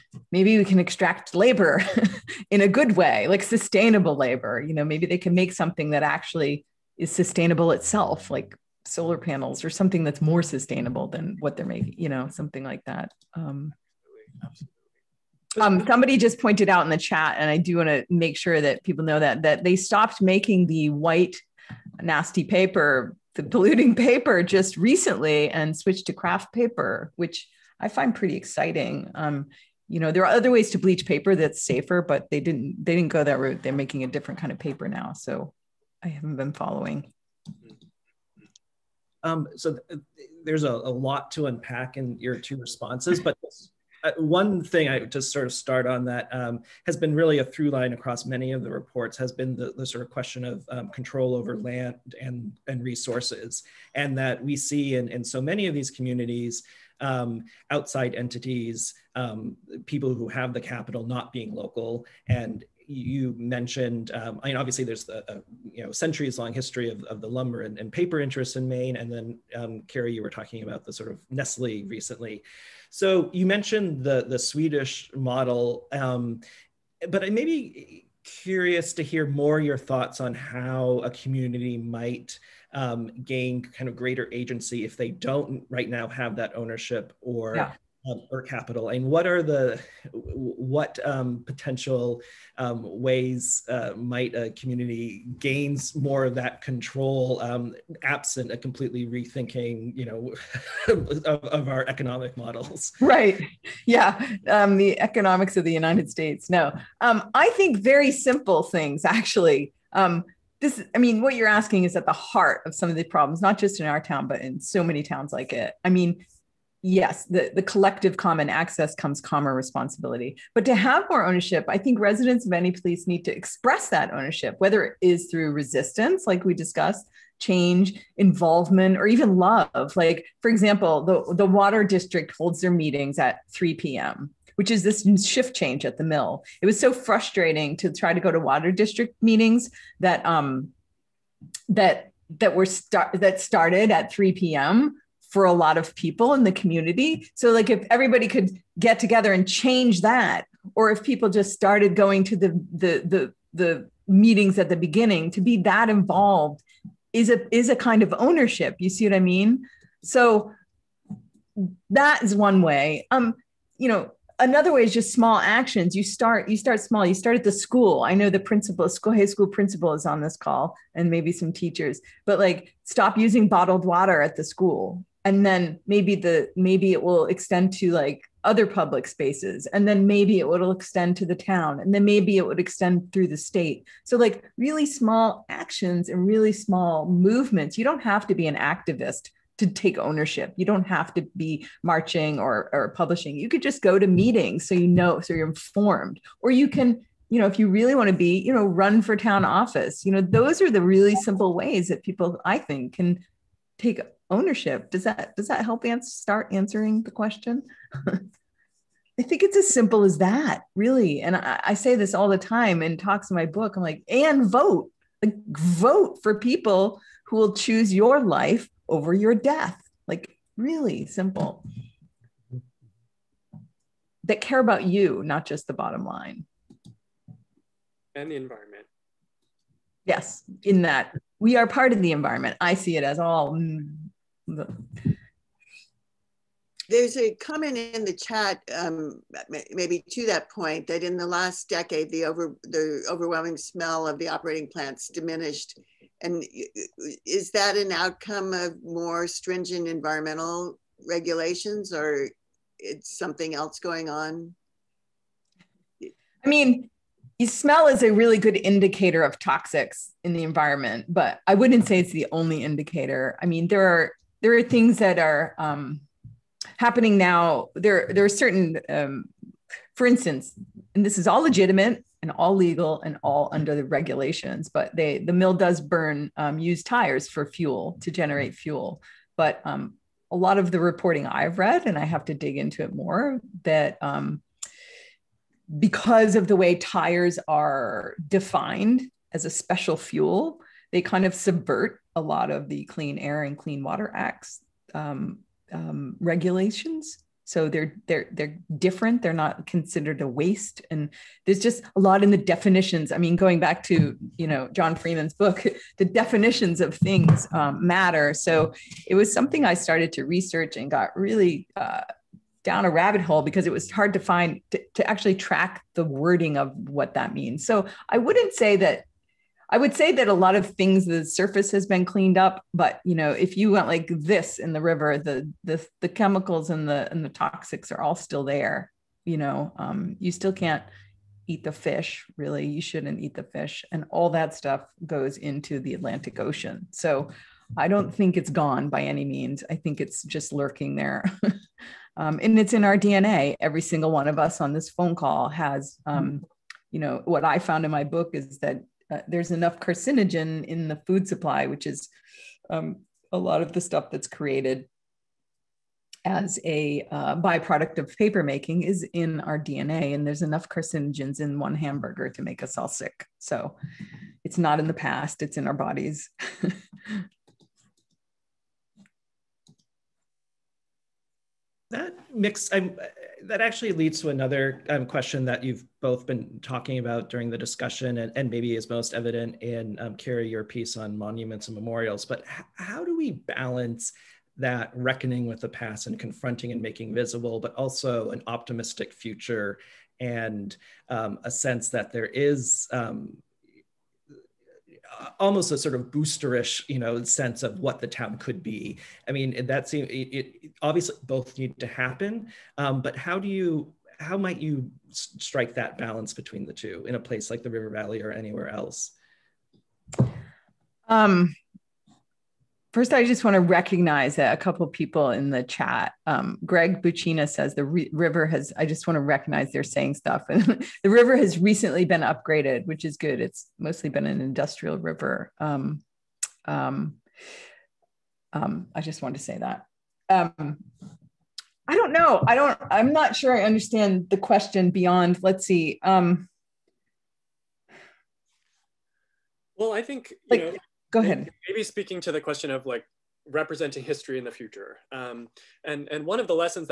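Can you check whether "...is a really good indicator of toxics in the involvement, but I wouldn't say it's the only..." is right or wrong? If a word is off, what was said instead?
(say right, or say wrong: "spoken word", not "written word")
wrong: "environment", not "involvement".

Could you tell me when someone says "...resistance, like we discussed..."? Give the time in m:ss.
2:05.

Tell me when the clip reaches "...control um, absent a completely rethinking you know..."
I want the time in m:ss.
1:36.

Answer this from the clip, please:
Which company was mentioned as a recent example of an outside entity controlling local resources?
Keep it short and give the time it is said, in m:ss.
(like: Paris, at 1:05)
Nestle, at 1:11.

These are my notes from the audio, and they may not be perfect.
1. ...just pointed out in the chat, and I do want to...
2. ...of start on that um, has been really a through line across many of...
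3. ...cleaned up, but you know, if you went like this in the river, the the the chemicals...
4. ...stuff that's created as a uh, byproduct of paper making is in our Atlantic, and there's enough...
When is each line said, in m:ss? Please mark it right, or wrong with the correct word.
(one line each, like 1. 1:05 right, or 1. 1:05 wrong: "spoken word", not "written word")
1. 0:16 right
2. 0:45 right
3. 5:22 right
4. 5:53 wrong: "DNA", not "Atlantic".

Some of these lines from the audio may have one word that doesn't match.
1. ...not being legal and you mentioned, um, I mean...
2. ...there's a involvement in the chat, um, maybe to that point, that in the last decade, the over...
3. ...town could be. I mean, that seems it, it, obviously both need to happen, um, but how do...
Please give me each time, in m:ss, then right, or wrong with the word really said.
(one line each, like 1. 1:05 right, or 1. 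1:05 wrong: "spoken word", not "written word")
1. 1:01 wrong: "local", not "legal"
2. 3:56 wrong: "comment", not "involvement"
3. 6:38 right.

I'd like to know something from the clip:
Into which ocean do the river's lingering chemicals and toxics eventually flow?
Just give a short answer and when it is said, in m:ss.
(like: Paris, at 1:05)
Atlantic Ocean, at 5:35.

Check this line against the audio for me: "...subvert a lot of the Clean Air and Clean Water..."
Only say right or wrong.
right.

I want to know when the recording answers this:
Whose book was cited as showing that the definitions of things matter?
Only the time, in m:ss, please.
5:04.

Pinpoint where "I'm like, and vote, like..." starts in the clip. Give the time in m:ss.
3:33.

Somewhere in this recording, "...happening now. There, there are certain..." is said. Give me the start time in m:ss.
4:26.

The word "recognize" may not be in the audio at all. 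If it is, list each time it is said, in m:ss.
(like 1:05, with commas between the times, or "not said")
6:53, 6:59.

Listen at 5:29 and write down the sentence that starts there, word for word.
You know, um, you still can't eat the fish.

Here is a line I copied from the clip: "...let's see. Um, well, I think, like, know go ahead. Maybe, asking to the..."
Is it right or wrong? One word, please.
wrong.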